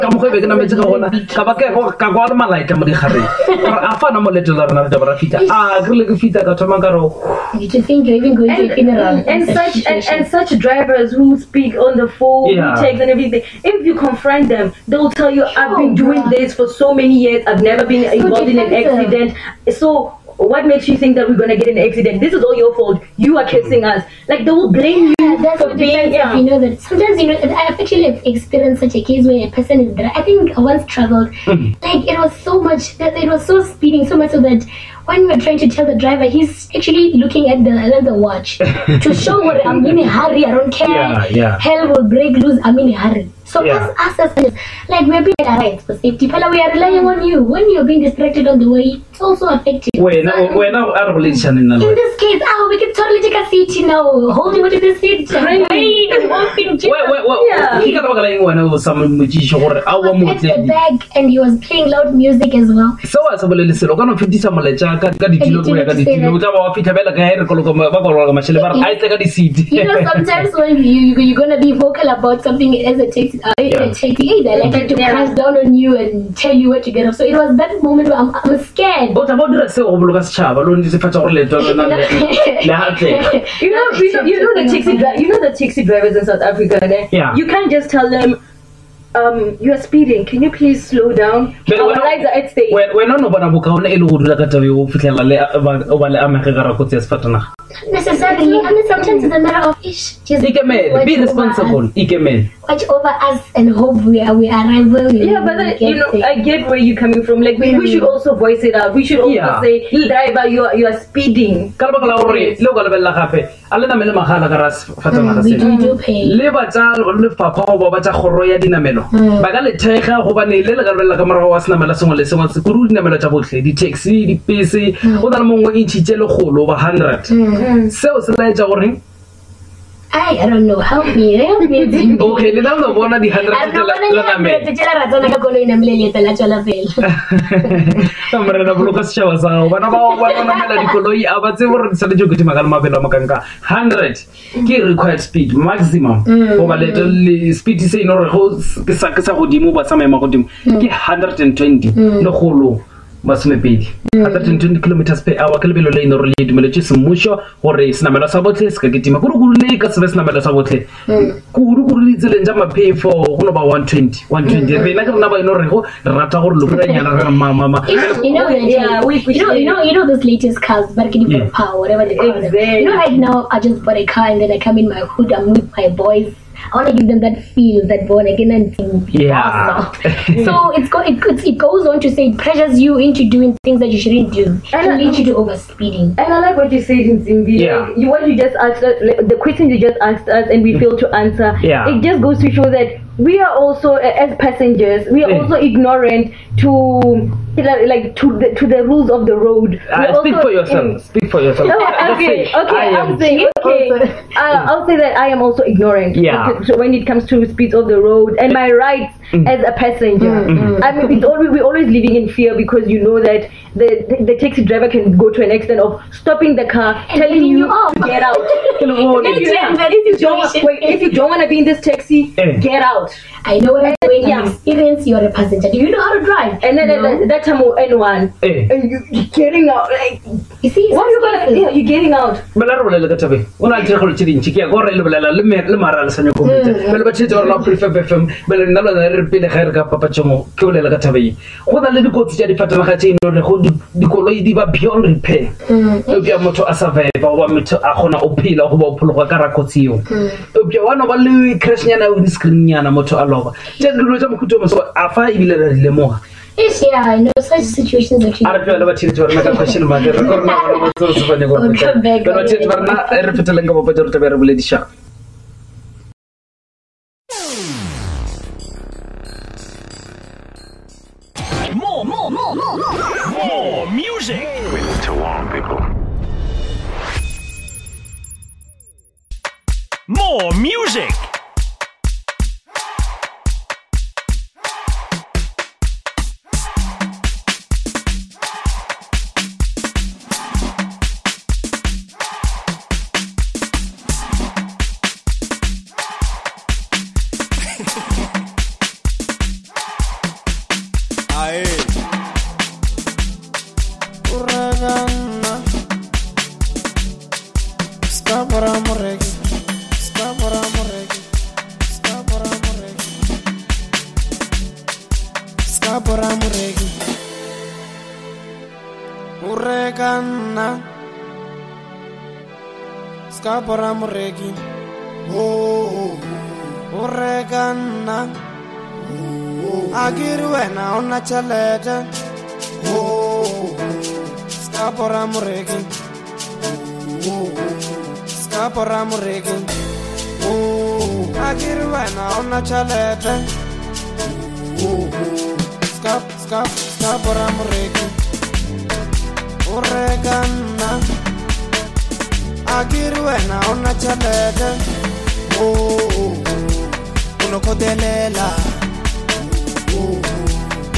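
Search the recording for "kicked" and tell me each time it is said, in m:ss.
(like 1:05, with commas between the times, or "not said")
not said.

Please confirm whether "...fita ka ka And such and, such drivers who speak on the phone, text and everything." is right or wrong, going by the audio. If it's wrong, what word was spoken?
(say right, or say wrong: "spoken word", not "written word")
right.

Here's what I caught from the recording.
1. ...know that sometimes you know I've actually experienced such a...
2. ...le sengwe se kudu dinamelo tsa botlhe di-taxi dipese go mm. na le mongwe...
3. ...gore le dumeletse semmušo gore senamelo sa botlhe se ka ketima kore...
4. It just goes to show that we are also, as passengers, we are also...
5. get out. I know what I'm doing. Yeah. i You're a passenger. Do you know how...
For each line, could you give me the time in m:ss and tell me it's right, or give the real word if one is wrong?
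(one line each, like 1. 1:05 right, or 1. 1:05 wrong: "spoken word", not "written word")
1. 0:26 right
2. 2:02 right
3. 2:36 right
4. 3:11 right
5. 3:42 right.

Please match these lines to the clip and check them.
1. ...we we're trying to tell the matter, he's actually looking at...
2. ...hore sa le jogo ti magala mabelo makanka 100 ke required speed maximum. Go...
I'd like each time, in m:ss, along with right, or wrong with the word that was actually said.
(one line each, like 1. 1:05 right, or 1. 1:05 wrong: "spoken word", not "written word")
1. 0:35 wrong: "driver", not "matter"
2. 2:21 right.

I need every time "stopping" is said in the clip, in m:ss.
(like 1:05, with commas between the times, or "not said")
3:36.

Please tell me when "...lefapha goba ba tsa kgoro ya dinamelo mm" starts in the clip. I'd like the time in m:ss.
1:57.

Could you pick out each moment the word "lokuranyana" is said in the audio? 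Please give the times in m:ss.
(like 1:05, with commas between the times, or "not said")
2:46.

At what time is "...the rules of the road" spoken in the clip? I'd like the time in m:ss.
3:18.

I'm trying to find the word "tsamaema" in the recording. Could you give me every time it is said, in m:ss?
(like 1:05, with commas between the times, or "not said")
2:29.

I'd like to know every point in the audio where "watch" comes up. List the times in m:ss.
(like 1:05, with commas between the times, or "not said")
0:38, 1:42.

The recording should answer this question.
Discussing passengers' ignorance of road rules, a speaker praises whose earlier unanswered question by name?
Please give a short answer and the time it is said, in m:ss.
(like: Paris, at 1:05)
Zimbi, at 3:07.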